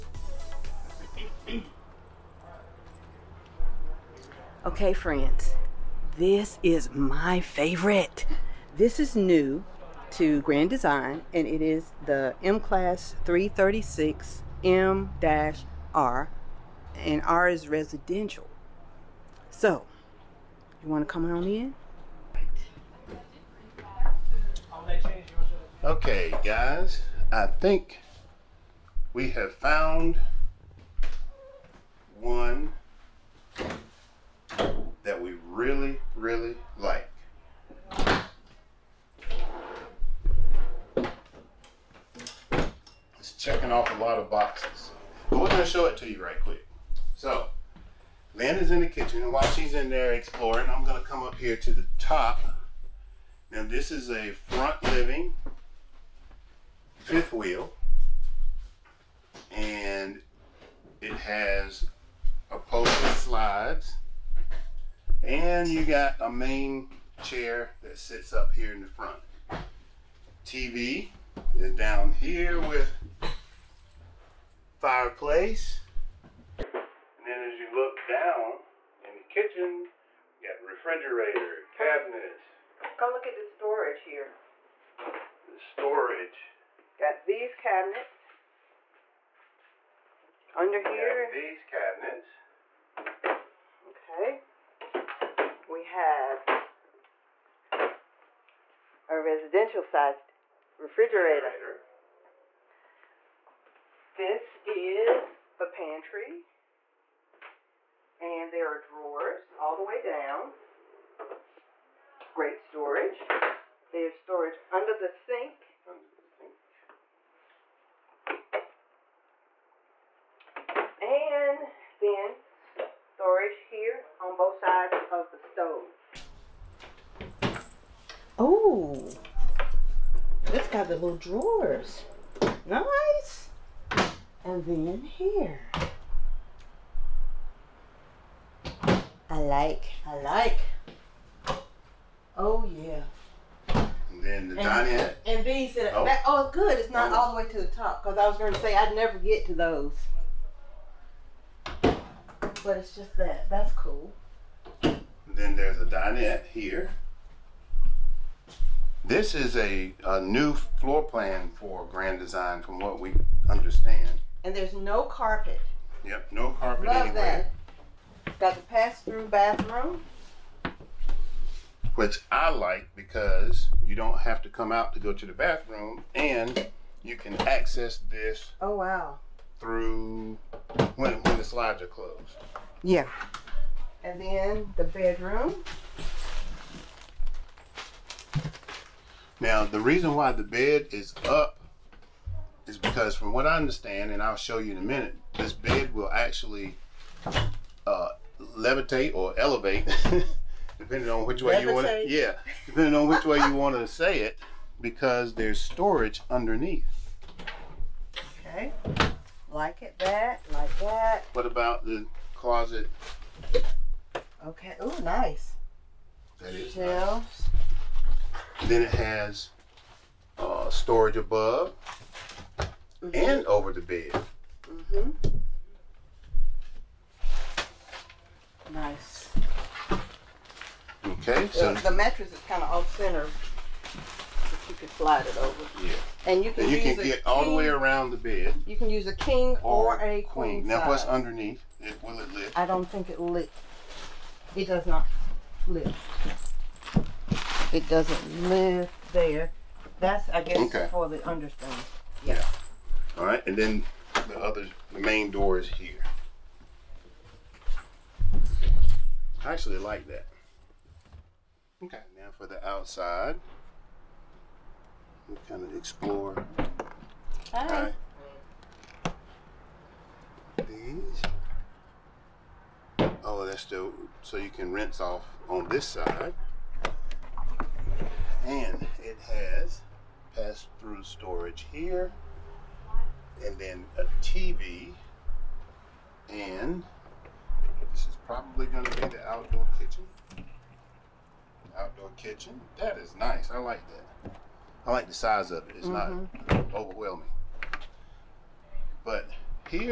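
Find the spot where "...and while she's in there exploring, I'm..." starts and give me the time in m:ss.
0:49.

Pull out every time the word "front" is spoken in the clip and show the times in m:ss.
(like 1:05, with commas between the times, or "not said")
0:54, 1:08.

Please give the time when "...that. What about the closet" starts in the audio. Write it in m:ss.
3:30.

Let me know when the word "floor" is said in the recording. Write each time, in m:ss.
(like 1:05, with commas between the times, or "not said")
2:40.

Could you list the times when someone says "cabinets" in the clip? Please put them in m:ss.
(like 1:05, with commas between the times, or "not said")
1:21, 1:27, 1:31.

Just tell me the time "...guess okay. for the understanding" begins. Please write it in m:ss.
4:10.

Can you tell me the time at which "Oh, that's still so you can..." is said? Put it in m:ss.
4:33.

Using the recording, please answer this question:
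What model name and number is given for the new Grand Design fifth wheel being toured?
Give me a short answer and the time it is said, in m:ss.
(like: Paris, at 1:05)
M-Class 336 M-R, at 0:12.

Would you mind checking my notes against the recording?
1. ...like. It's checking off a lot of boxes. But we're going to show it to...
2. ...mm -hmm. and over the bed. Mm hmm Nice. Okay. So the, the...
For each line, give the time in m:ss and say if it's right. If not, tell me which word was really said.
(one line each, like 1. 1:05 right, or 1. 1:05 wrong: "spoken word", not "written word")
1. 0:36 right
2. 3:42 right.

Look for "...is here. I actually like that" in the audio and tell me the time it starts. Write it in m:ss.
4:15.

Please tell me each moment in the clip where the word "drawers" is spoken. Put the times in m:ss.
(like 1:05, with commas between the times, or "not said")
1:48, 2:11.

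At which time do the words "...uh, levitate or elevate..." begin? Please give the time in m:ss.
3:17.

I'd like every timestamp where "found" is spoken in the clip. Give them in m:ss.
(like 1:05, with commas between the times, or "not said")
0:29.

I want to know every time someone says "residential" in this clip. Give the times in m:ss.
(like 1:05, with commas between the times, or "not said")
0:17, 1:39.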